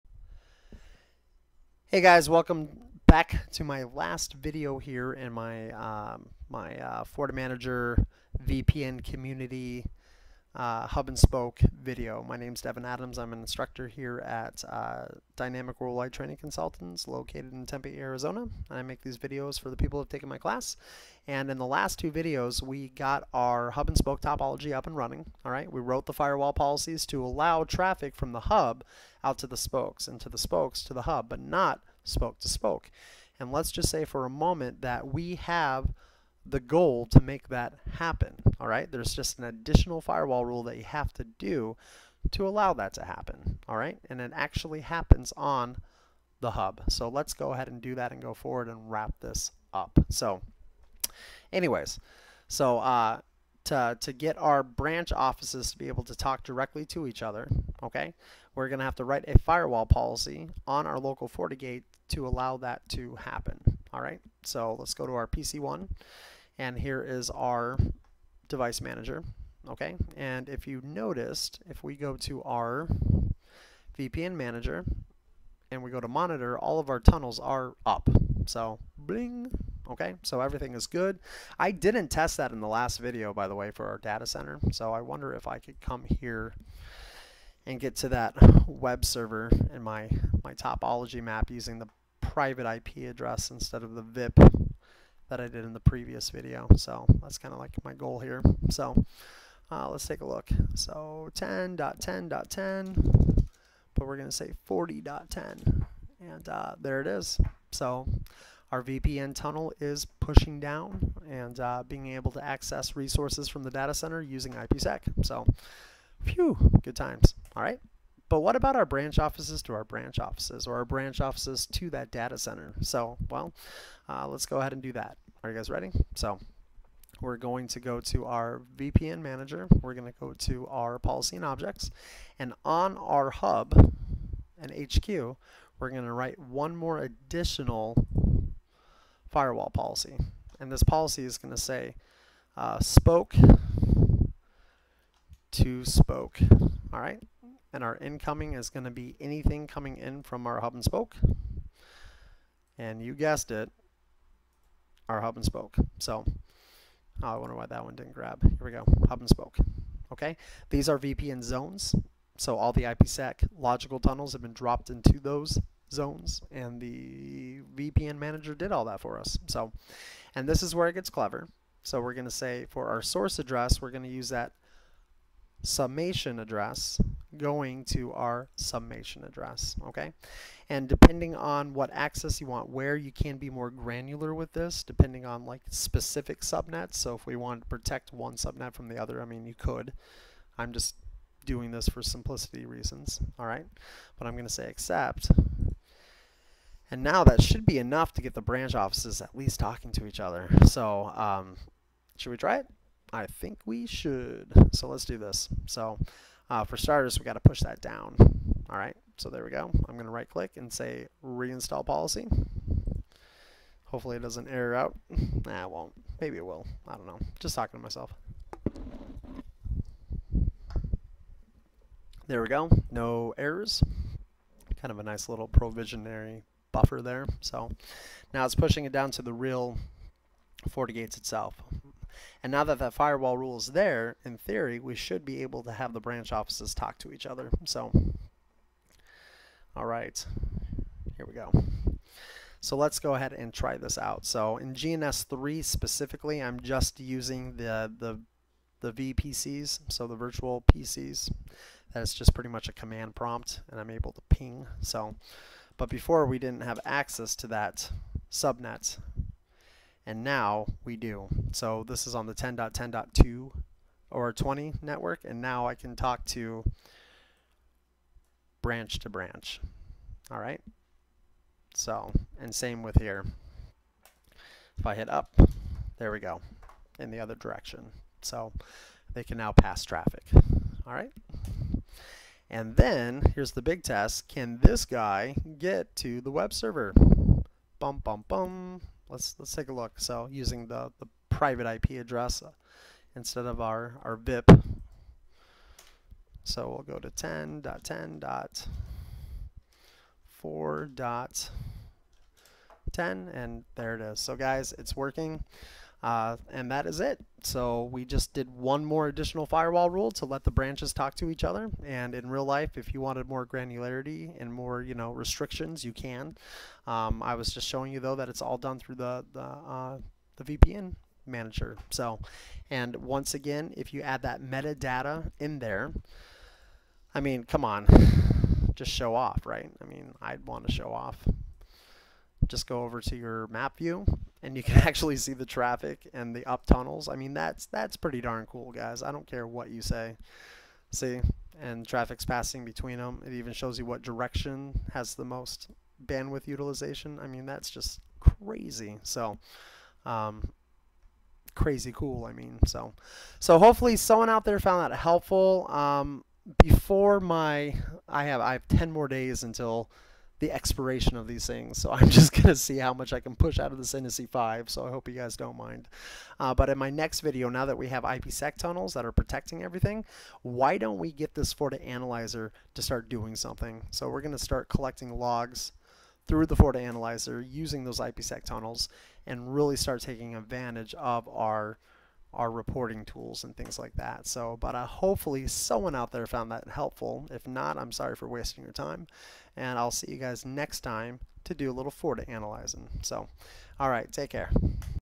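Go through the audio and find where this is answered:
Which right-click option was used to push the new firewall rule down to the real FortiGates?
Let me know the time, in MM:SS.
03:31.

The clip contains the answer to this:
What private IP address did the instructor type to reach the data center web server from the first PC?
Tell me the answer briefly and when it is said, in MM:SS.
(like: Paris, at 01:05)
10.10.40.10, at 01:44.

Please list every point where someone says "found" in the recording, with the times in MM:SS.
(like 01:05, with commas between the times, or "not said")
05:54, 06:26.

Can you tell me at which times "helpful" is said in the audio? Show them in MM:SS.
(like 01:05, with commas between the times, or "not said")
05:54, 06:26.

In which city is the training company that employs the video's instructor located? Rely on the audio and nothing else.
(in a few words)
Tempe, Arizona.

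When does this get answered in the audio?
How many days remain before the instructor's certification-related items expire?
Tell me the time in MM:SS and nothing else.
05:58.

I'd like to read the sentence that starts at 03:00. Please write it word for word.
And depending on what access you want where, you can be more granular with this, depending on like specific subnets.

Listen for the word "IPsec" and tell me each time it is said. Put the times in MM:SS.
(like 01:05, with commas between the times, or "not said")
01:54, 02:42, 06:08, 06:17.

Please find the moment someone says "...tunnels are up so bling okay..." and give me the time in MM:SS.
01:16.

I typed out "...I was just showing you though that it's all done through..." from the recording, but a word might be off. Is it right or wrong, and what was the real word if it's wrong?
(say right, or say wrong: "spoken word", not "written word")
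right.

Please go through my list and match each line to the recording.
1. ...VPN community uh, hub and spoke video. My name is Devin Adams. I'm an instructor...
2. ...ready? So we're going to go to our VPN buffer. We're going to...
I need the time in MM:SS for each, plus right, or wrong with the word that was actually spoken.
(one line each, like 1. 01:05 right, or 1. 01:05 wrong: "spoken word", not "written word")
1. 00:08 right
2. 02:05 wrong: "manager", not "buffer".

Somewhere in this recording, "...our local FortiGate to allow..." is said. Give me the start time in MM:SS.
01:00.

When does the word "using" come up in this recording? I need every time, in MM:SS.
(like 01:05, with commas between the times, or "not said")
01:31, 01:54, 04:06, 04:50, 06:17.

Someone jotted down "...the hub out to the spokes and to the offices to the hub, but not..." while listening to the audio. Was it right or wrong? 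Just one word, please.
wrong.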